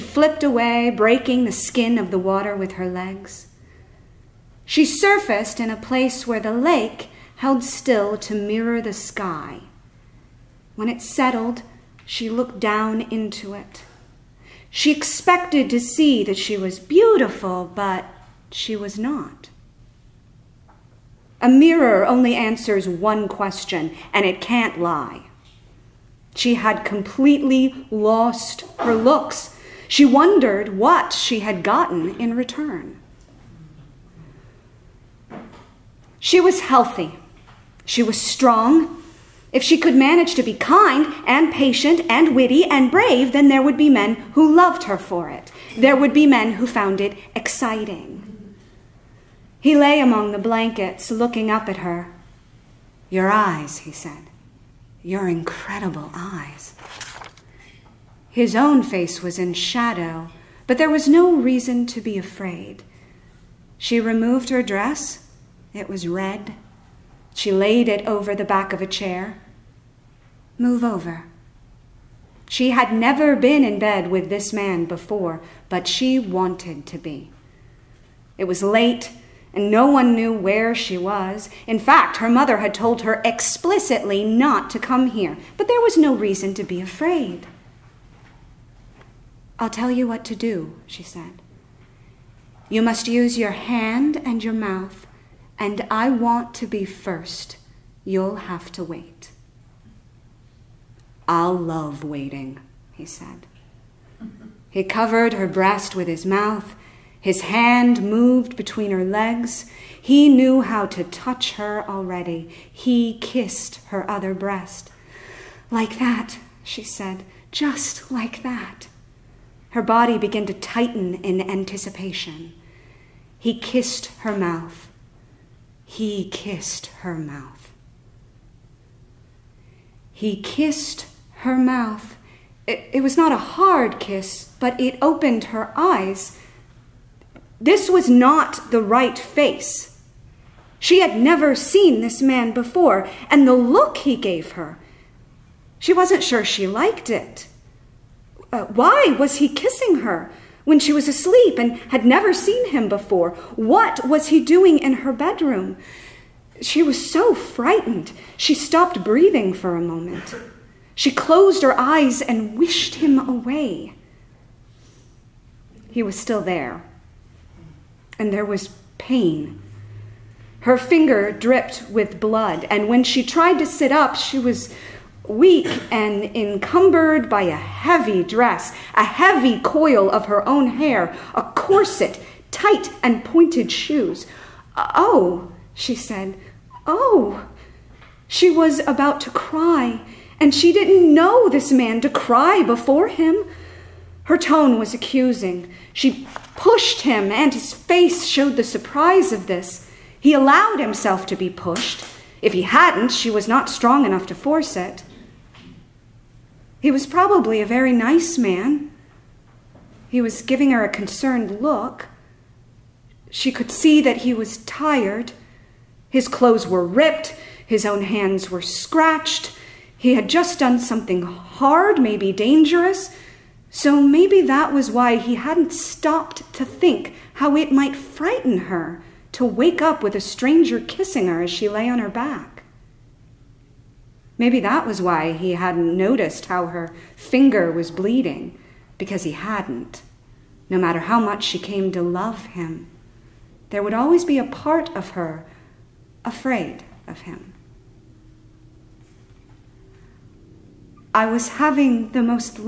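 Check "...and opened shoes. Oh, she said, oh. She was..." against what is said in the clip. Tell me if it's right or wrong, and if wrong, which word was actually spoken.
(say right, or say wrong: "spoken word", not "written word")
wrong: "pointed", not "opened".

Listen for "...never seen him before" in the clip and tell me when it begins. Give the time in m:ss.
2:32.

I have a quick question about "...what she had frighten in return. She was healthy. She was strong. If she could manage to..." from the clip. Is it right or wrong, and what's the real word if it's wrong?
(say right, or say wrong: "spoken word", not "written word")
wrong: "gotten", not "frighten".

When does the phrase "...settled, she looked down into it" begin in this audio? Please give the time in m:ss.
0:11.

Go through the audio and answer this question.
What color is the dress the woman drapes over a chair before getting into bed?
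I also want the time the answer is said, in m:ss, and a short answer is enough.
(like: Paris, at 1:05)
red, at 1:06.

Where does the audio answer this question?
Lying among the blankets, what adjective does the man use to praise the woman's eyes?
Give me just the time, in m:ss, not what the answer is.
0:55.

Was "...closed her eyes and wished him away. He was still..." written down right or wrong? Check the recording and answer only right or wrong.
right.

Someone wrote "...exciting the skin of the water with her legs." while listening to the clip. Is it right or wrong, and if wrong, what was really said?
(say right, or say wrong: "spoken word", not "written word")
wrong: "breaking", not "exciting".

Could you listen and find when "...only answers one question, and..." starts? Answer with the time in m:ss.
0:22.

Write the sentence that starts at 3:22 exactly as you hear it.
If he hadn't, she was not strong enough to force it.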